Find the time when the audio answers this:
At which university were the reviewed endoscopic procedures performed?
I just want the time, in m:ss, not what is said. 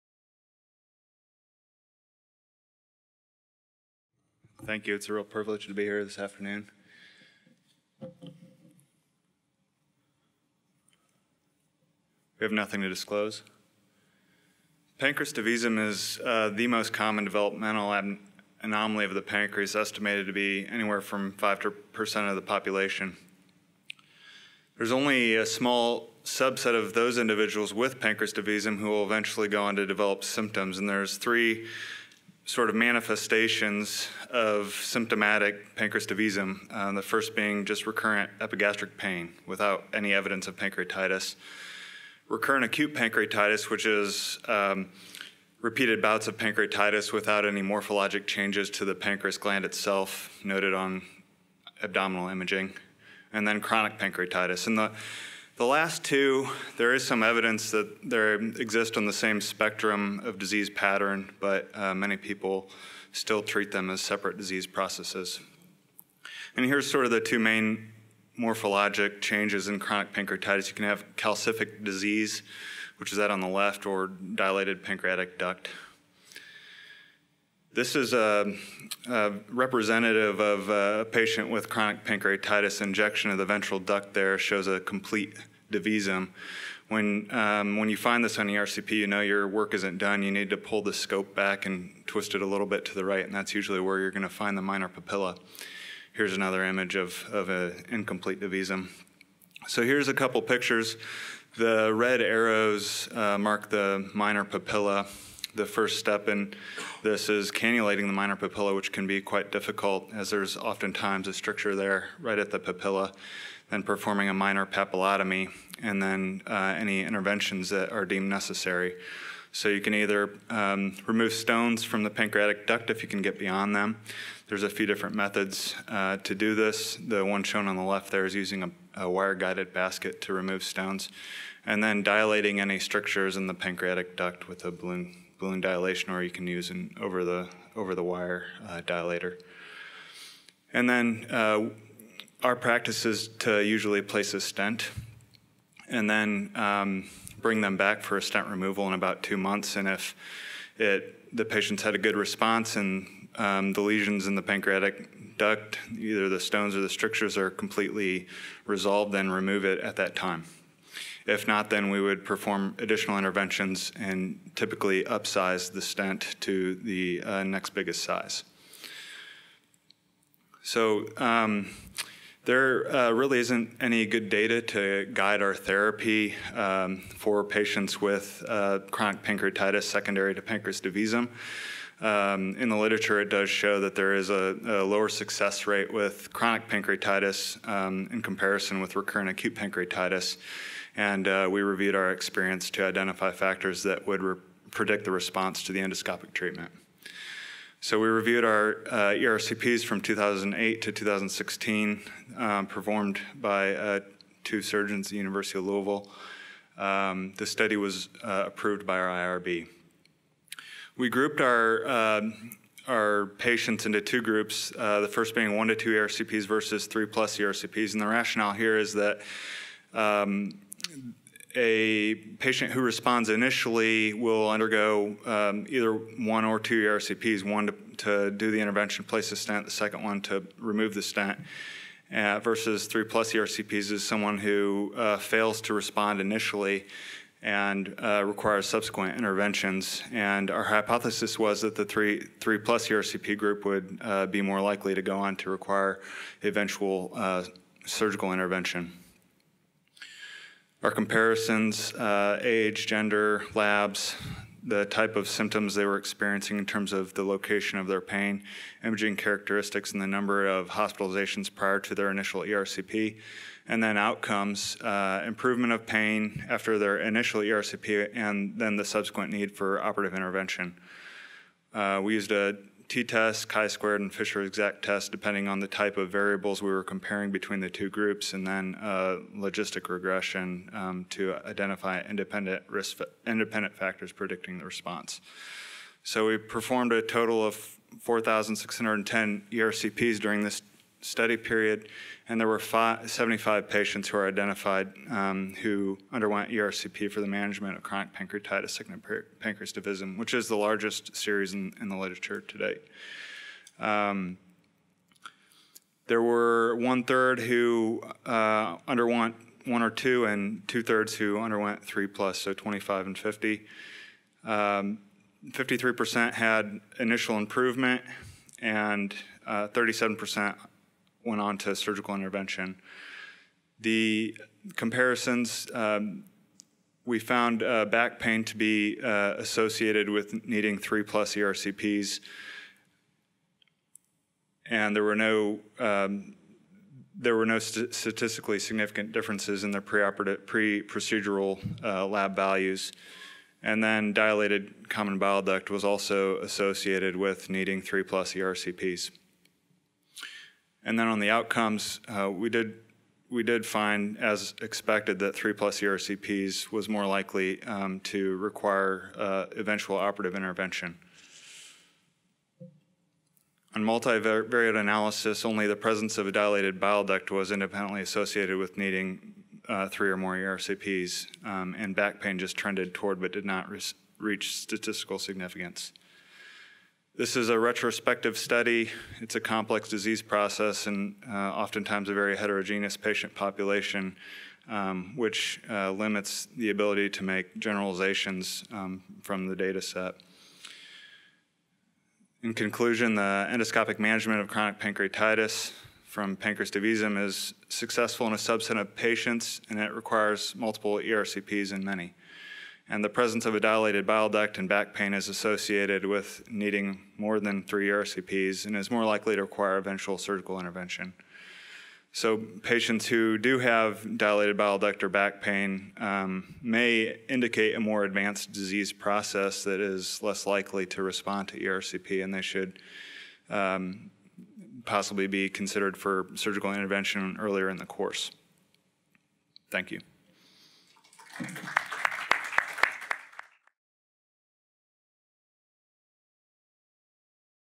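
3:25.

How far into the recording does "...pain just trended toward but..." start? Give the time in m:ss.
6:12.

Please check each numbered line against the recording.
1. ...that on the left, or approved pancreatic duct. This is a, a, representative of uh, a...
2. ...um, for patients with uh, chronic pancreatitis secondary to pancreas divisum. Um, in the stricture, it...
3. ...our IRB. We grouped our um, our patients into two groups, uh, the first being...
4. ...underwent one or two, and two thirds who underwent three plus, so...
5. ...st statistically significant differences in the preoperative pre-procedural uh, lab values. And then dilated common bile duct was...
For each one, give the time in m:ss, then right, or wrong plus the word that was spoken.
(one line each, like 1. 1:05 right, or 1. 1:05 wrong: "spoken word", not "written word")
1. 1:13 wrong: "dilated", not "approved"
2. 2:56 wrong: "literature", not "stricture"
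3. 3:28 right
4. 5:08 right
5. 5:37 right.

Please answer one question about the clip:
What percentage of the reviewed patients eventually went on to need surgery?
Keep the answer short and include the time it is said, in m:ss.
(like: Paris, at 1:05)
37%, at 5:19.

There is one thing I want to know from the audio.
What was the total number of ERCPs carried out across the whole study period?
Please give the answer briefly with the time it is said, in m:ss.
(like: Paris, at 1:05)
4,610, at 4:48.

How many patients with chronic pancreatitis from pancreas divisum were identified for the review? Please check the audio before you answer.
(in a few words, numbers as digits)
75.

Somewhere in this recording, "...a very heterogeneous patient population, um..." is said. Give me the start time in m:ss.
6:22.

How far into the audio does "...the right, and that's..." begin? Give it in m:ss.
1:32.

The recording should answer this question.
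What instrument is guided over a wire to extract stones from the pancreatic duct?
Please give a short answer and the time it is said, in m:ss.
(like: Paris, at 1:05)
basket, at 2:09.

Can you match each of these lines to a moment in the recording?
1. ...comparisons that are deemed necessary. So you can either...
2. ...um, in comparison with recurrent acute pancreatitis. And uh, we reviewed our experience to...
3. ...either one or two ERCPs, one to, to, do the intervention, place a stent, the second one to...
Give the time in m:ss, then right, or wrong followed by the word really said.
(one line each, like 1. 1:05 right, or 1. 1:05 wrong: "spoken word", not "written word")
1. 1:57 wrong: "interventions", not "comparisons"
2. 3:07 right
3. 3:45 right.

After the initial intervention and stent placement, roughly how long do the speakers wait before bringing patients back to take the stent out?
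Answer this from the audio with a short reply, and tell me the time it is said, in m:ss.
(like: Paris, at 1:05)
2 months, at 2:29.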